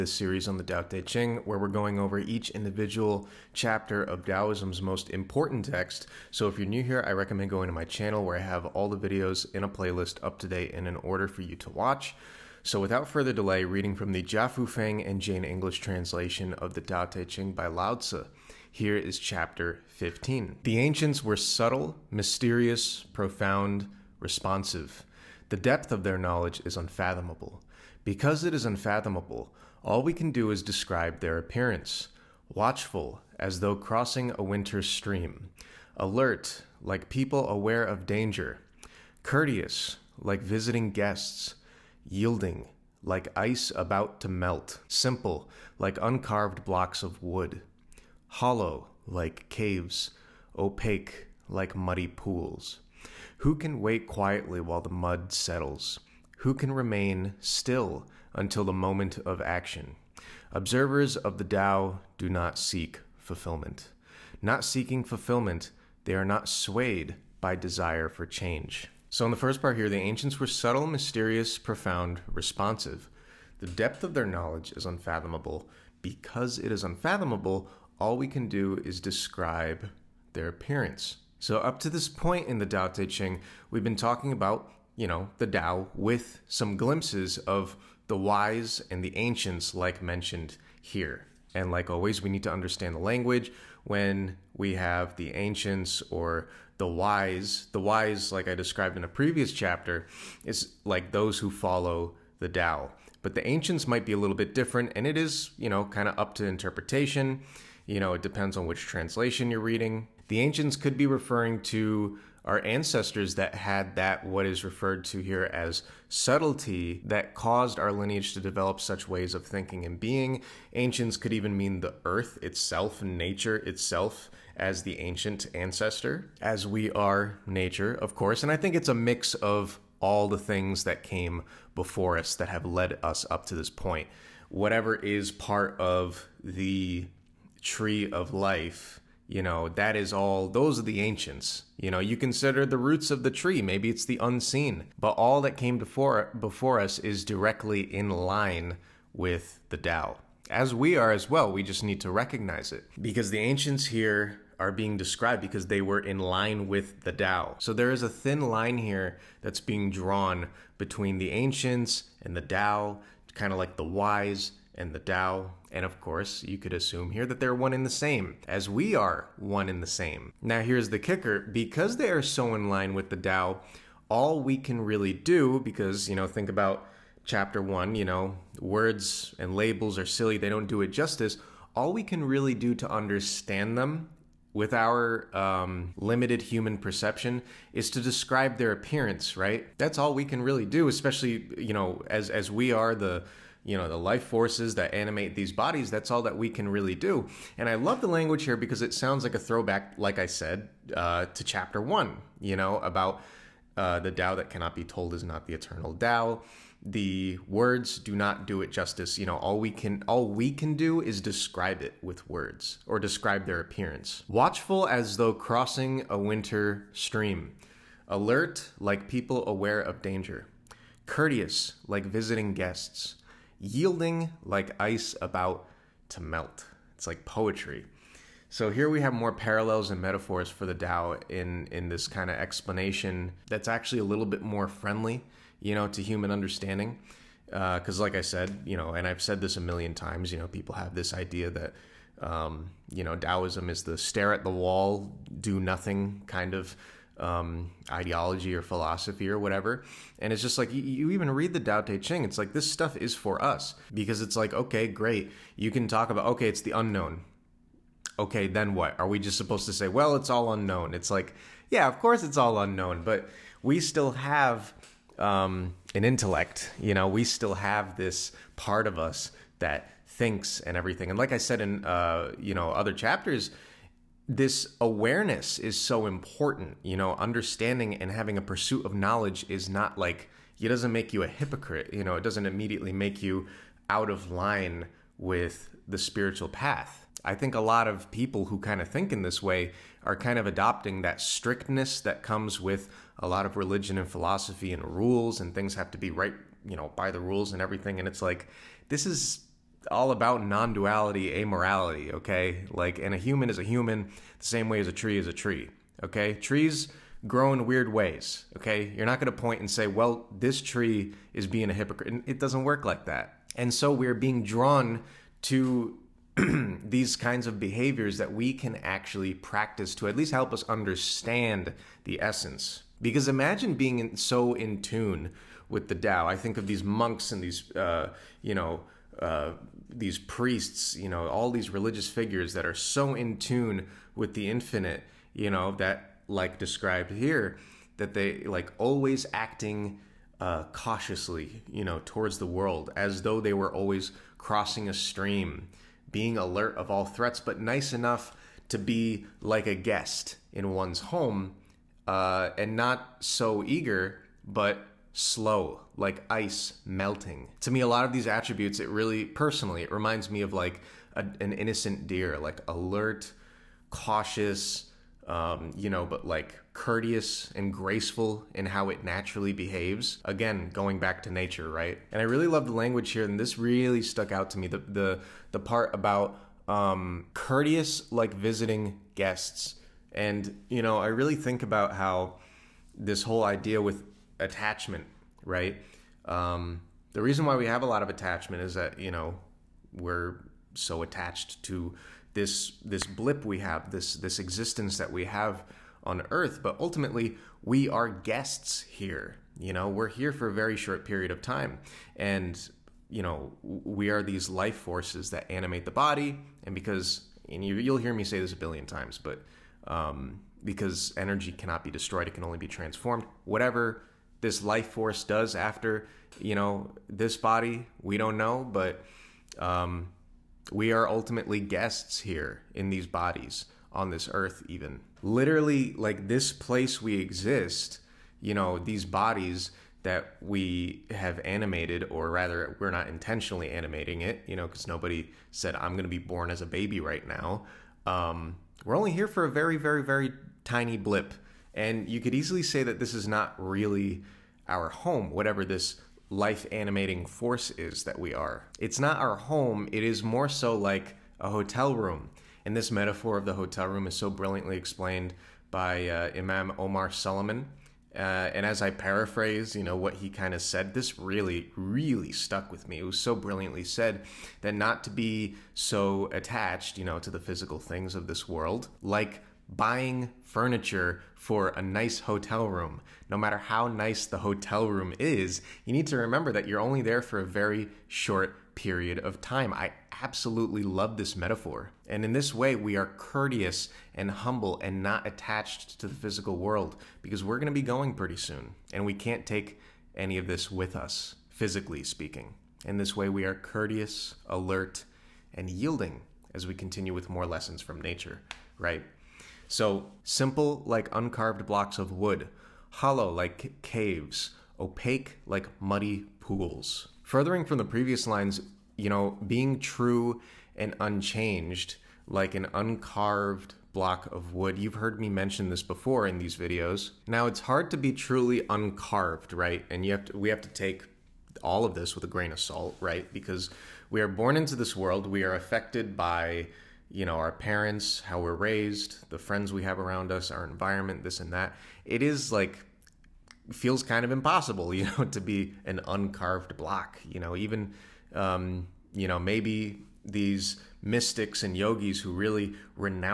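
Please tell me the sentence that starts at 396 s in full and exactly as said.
But ultimately, we are guests here.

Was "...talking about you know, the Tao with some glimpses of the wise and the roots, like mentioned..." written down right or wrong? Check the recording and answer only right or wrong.
wrong.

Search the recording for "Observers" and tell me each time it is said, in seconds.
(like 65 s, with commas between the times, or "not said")
60 s.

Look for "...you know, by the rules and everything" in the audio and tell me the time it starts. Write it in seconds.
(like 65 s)
296 s.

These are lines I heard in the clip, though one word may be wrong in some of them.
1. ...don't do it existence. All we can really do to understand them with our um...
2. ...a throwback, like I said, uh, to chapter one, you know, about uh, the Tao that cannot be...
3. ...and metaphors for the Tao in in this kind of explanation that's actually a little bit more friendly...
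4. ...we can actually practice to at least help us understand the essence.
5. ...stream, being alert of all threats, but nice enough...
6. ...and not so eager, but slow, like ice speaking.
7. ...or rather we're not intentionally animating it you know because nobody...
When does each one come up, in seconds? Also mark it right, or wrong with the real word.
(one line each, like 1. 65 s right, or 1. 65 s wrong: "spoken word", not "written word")
1. 180 s wrong: "justice", not "existence"
2. 199 s right
3. 229 s right
4. 318 s right
5. 344 s right
6. 352 s wrong: "melting", not "speaking"
7. 432 s right.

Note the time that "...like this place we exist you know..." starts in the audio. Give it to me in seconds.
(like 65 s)
425 s.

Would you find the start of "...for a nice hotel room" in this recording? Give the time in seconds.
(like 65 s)
471 s.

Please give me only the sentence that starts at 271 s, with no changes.
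And like I said in uh, you know other chapters, this awareness is so important.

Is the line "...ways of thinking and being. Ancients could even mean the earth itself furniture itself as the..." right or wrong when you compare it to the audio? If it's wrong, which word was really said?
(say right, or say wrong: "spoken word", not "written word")
wrong: "nature", not "furniture".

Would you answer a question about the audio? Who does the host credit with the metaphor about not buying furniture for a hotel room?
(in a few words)
Imam Omar Suleiman.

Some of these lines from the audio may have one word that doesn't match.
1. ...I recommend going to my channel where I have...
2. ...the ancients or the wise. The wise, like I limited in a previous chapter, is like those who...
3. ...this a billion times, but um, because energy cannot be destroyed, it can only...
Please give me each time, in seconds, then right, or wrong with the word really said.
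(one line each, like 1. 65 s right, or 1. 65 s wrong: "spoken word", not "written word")
1. 7 s right
2. 95 s wrong: "described", not "limited"
3. 408 s right.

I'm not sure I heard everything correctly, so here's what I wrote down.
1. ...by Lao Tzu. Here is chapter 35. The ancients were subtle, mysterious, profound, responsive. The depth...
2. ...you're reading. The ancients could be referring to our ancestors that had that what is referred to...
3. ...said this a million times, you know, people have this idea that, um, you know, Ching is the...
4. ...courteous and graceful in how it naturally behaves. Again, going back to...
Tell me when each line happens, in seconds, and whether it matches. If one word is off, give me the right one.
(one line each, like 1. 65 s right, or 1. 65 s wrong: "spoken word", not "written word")
1. 17 s wrong: "15", not "35"
2. 109 s right
3. 239 s wrong: "Taoism", not "Ching"
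4. 366 s right.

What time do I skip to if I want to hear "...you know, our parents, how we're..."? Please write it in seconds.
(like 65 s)
527 s.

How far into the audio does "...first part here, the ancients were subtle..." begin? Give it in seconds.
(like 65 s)
69 s.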